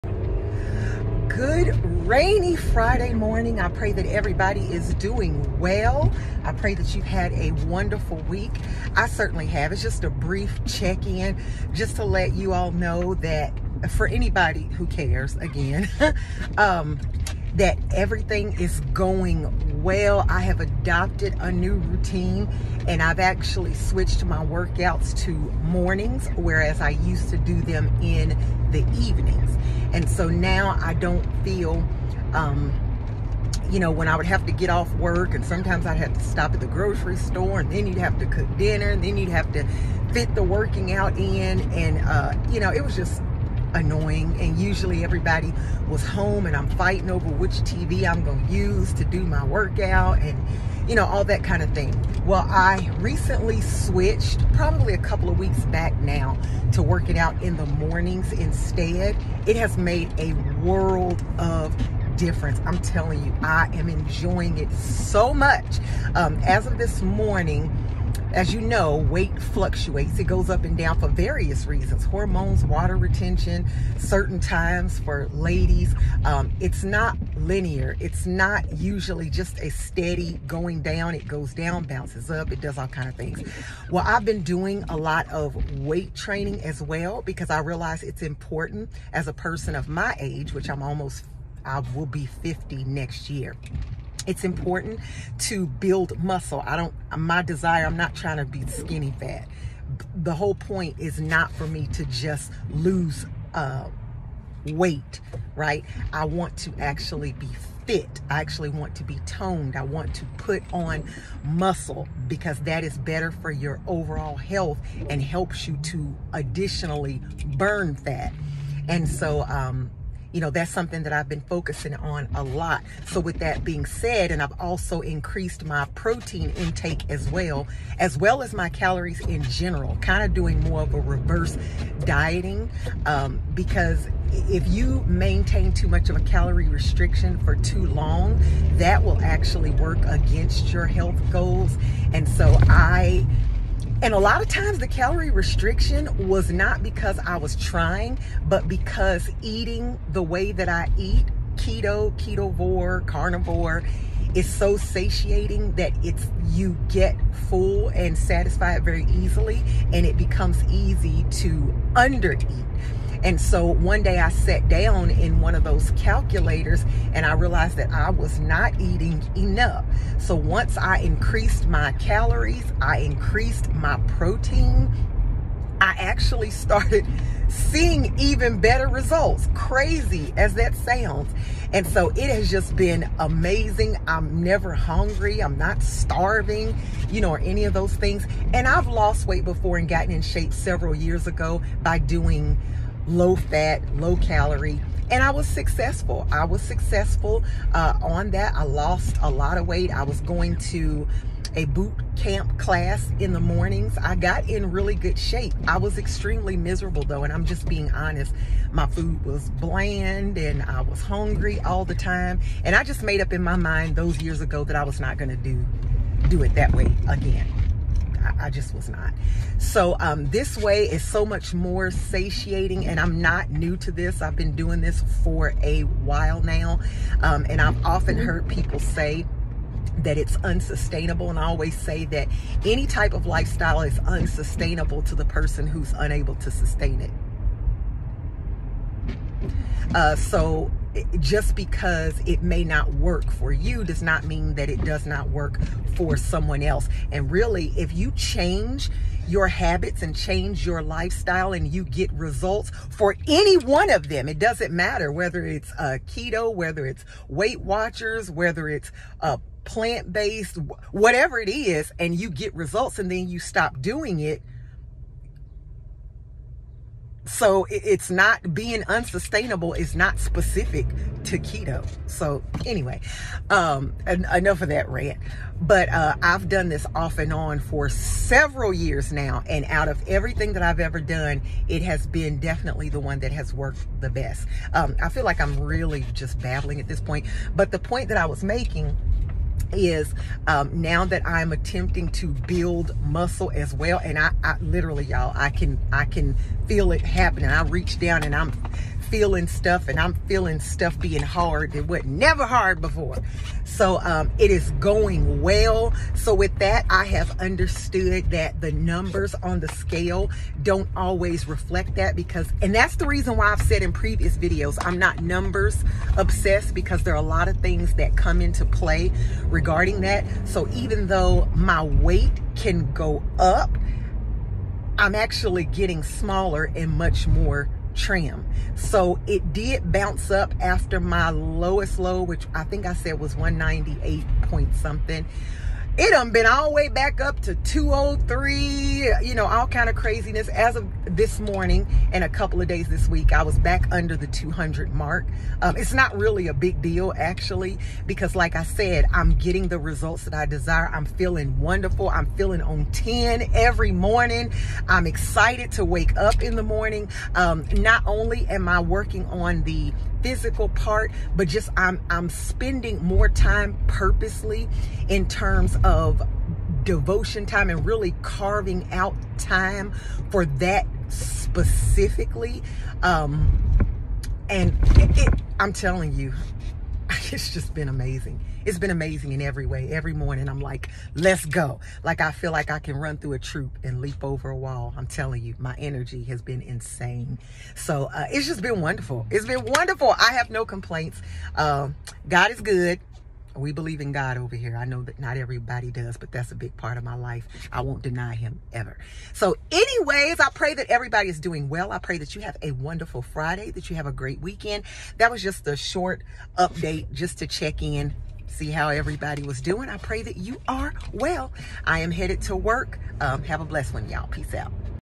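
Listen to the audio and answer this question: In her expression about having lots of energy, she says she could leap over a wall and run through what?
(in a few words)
a troop.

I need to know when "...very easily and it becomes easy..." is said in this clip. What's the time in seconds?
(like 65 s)
158 s.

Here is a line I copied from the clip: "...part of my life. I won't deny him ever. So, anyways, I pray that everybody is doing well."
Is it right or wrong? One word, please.
right.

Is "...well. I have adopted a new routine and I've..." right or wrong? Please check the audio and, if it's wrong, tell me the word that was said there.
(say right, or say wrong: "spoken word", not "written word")
right.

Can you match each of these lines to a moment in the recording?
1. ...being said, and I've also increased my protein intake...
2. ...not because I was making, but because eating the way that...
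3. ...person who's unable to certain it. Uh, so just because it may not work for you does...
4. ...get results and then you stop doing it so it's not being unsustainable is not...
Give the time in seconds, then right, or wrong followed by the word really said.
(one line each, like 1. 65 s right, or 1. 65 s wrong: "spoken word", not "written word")
1. 123 s right
2. 146 s wrong: "trying", not "making"
3. 235 s wrong: "sustain", not "certain"
4. 262 s right.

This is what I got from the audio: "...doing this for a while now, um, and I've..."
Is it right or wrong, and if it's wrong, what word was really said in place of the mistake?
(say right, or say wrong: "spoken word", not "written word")
right.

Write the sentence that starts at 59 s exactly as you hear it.
It has made a world of difference.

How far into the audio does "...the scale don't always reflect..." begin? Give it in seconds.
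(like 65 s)
309 s.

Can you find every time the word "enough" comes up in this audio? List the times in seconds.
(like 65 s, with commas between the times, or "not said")
169 s, 274 s.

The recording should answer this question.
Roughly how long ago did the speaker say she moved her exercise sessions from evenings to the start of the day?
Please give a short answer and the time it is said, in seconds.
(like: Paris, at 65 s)
a couple of weeks, at 54 s.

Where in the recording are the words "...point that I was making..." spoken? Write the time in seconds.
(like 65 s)
287 s.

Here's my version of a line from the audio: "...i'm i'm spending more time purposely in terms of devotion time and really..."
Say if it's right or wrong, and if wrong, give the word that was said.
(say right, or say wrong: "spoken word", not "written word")
right.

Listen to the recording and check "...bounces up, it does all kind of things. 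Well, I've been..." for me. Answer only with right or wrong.
right.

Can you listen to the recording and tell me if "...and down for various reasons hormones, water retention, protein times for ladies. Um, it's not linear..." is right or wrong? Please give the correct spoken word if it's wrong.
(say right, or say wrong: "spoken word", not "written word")
wrong: "certain", not "protein".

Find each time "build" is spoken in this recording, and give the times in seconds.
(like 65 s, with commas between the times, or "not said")
95 s, 292 s.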